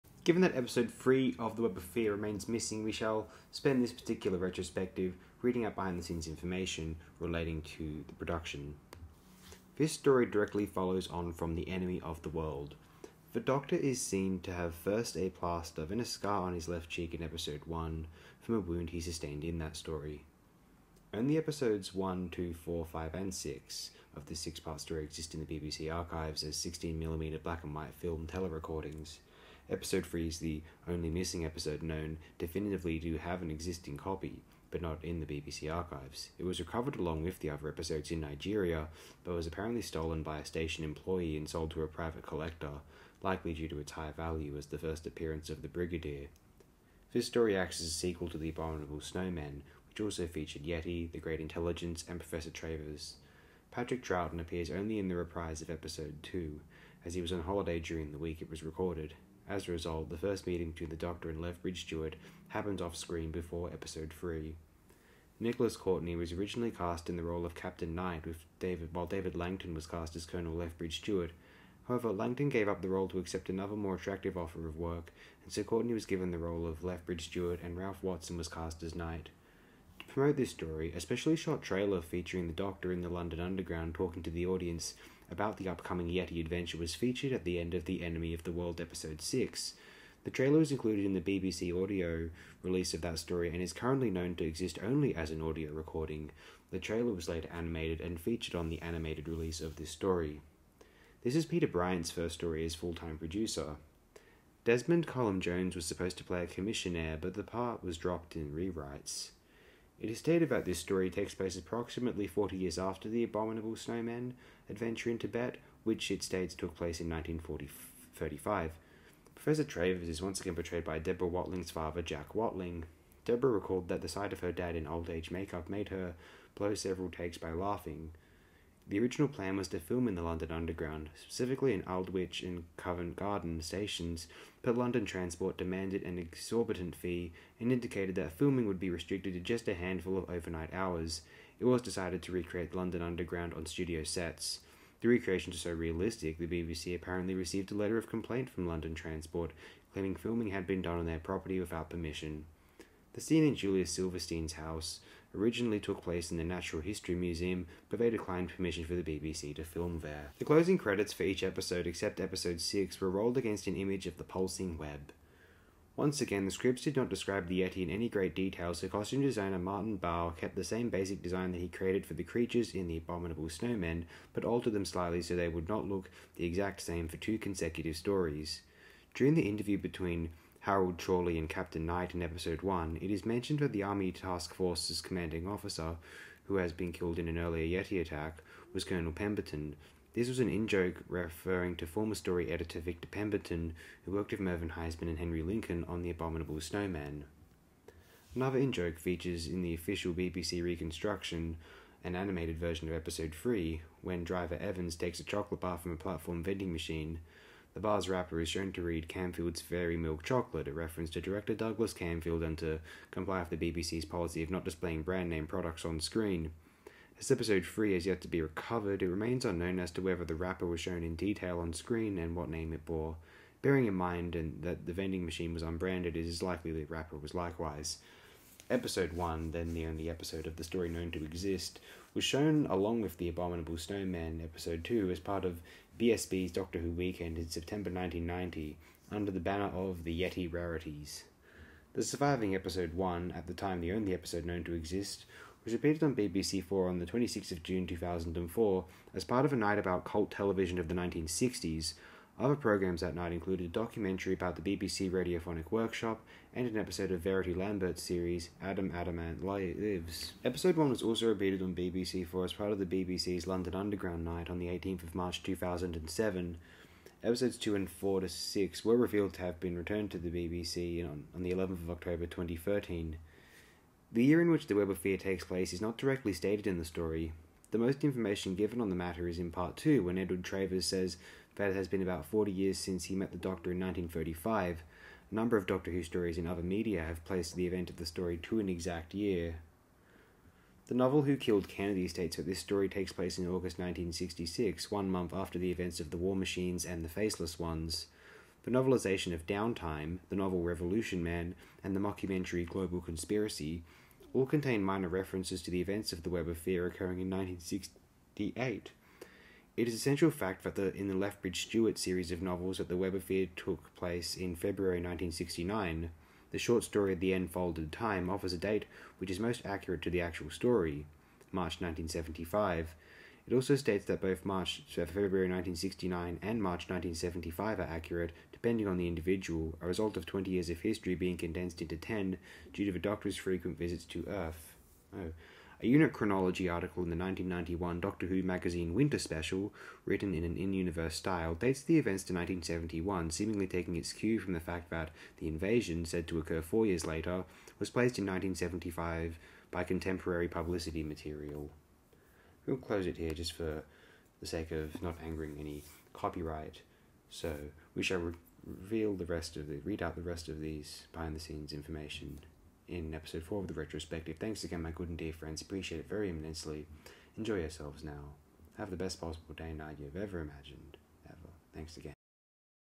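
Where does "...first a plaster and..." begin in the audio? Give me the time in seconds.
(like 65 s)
14 s.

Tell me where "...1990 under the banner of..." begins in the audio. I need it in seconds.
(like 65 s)
237 s.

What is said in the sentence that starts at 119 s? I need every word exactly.
Professor Travers is once again portrayed by Deborah Watling's father, Jack Watling.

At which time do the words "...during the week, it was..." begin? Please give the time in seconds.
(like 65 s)
57 s.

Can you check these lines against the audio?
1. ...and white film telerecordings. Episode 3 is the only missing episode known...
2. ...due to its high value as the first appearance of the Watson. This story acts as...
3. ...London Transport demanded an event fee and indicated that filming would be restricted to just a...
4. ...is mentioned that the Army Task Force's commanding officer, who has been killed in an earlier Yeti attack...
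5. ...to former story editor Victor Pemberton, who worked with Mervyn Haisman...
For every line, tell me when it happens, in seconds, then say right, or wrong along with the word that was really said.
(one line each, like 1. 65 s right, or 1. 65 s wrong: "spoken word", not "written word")
1. 27 s right
2. 43 s wrong: "Brigadier", not "Watson"
3. 134 s wrong: "exorbitant", not "event"
4. 183 s right
5. 191 s right.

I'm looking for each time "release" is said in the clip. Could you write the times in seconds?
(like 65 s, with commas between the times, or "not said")
92 s, 99 s.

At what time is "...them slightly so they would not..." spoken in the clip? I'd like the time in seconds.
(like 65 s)
174 s.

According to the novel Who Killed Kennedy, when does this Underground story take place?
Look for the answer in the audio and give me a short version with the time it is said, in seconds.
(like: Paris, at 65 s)
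August 1966, at 293 s.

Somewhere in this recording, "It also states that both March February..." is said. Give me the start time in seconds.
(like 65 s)
323 s.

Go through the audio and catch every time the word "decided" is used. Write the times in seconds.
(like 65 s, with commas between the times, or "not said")
141 s.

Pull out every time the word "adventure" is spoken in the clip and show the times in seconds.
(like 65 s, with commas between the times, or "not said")
86 s, 114 s.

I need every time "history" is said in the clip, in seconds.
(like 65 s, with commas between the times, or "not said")
156 s, 330 s.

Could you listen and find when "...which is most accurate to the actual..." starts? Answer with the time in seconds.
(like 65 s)
319 s.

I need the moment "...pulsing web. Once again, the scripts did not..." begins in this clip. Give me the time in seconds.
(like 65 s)
164 s.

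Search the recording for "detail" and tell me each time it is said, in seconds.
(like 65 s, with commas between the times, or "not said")
168 s, 221 s.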